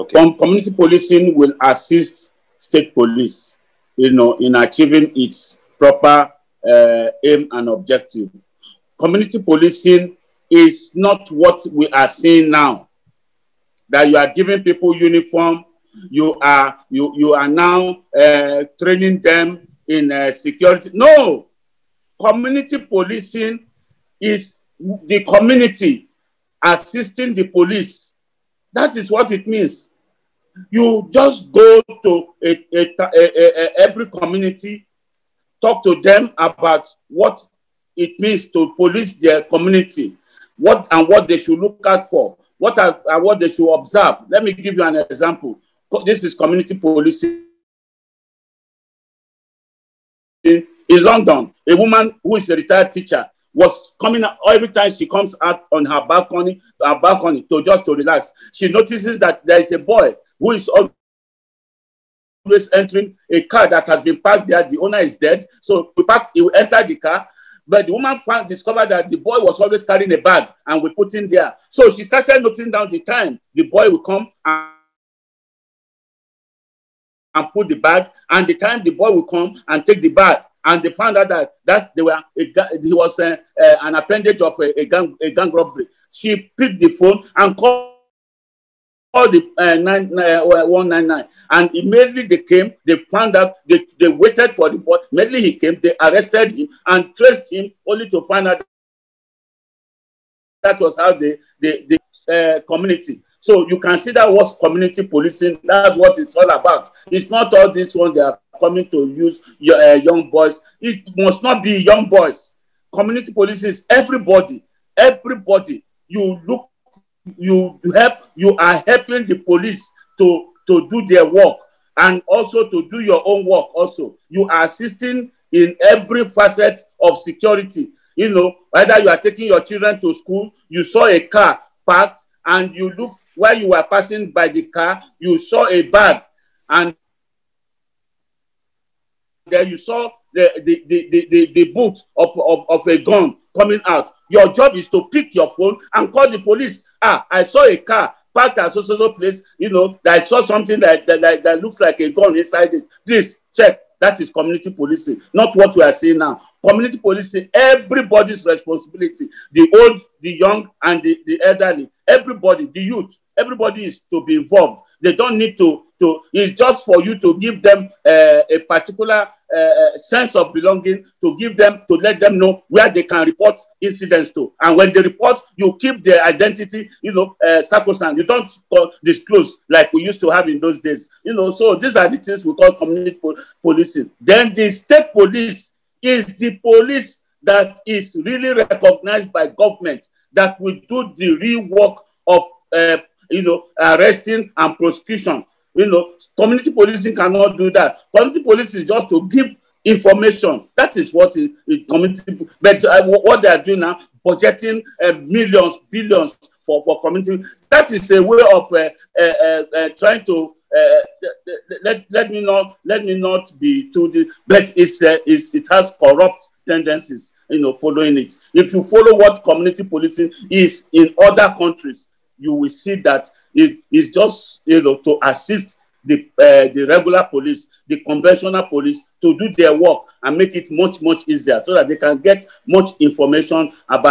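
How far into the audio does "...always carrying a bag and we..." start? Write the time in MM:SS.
01:09.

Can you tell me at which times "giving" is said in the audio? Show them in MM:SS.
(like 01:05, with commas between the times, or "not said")
00:14.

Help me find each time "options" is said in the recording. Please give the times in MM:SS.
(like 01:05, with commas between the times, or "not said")
not said.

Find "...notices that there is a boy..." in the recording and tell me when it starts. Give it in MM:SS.
00:58.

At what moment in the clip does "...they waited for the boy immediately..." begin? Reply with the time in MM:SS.
01:33.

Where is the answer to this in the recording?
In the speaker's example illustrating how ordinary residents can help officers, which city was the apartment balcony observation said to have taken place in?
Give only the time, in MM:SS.
00:51.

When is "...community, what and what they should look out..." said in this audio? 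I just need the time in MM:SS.
00:39.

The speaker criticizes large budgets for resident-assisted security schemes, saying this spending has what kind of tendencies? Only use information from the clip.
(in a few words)
Corrupt tendencies.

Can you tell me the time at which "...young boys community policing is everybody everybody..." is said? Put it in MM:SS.
01:51.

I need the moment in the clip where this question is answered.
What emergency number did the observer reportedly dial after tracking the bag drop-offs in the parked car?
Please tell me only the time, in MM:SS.
01:30.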